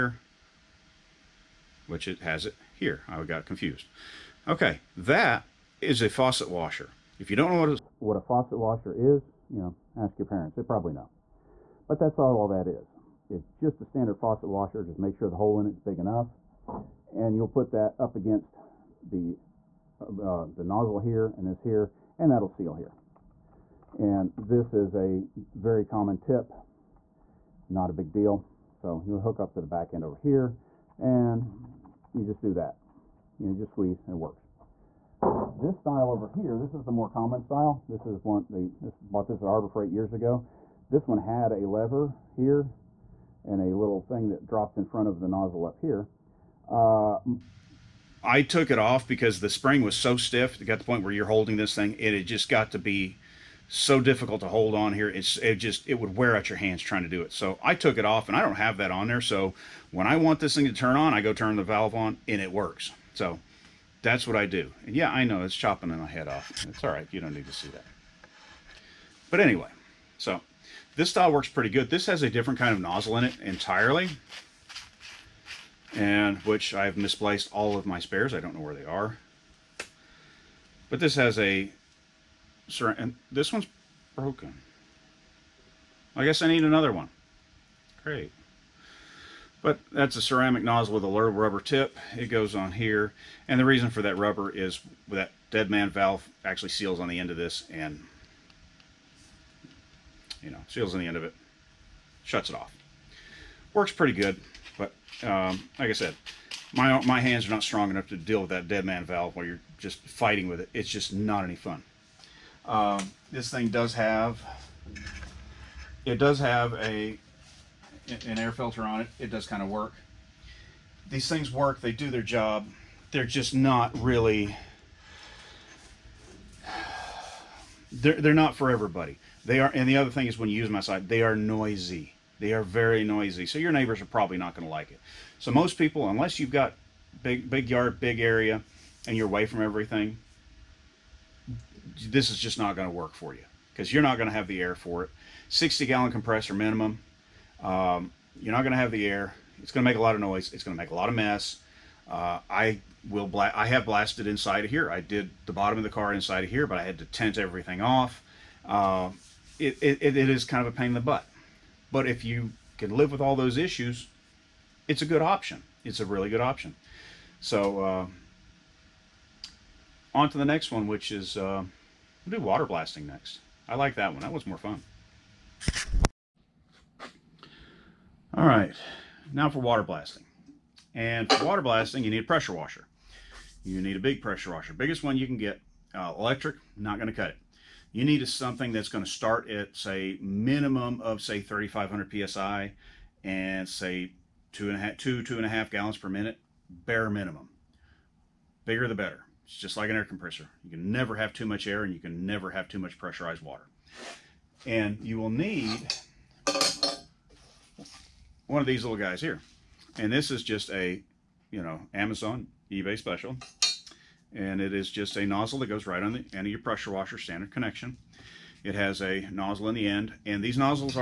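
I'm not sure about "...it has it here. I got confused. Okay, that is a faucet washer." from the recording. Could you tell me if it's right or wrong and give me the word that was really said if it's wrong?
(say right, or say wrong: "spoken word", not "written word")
right.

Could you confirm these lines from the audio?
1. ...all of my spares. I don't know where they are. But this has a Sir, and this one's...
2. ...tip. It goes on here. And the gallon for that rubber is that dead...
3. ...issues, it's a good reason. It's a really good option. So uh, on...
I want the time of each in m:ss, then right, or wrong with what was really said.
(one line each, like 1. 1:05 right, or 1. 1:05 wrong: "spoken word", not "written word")
1. 1:17 right
2. 1:31 wrong: "reason", not "gallon"
3. 2:43 wrong: "option", not "reason".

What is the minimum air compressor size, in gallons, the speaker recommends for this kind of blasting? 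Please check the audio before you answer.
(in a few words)
60 gallons.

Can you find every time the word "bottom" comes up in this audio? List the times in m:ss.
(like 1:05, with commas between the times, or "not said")
2:35.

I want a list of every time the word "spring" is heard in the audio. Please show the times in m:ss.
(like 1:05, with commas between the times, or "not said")
0:49.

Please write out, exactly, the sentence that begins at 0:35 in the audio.
This style over here, this is the more common style.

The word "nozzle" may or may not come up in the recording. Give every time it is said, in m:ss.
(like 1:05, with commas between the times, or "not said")
0:20, 0:45, 1:12, 1:30, 3:35, 3:39.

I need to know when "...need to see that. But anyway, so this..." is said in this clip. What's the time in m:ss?
1:07.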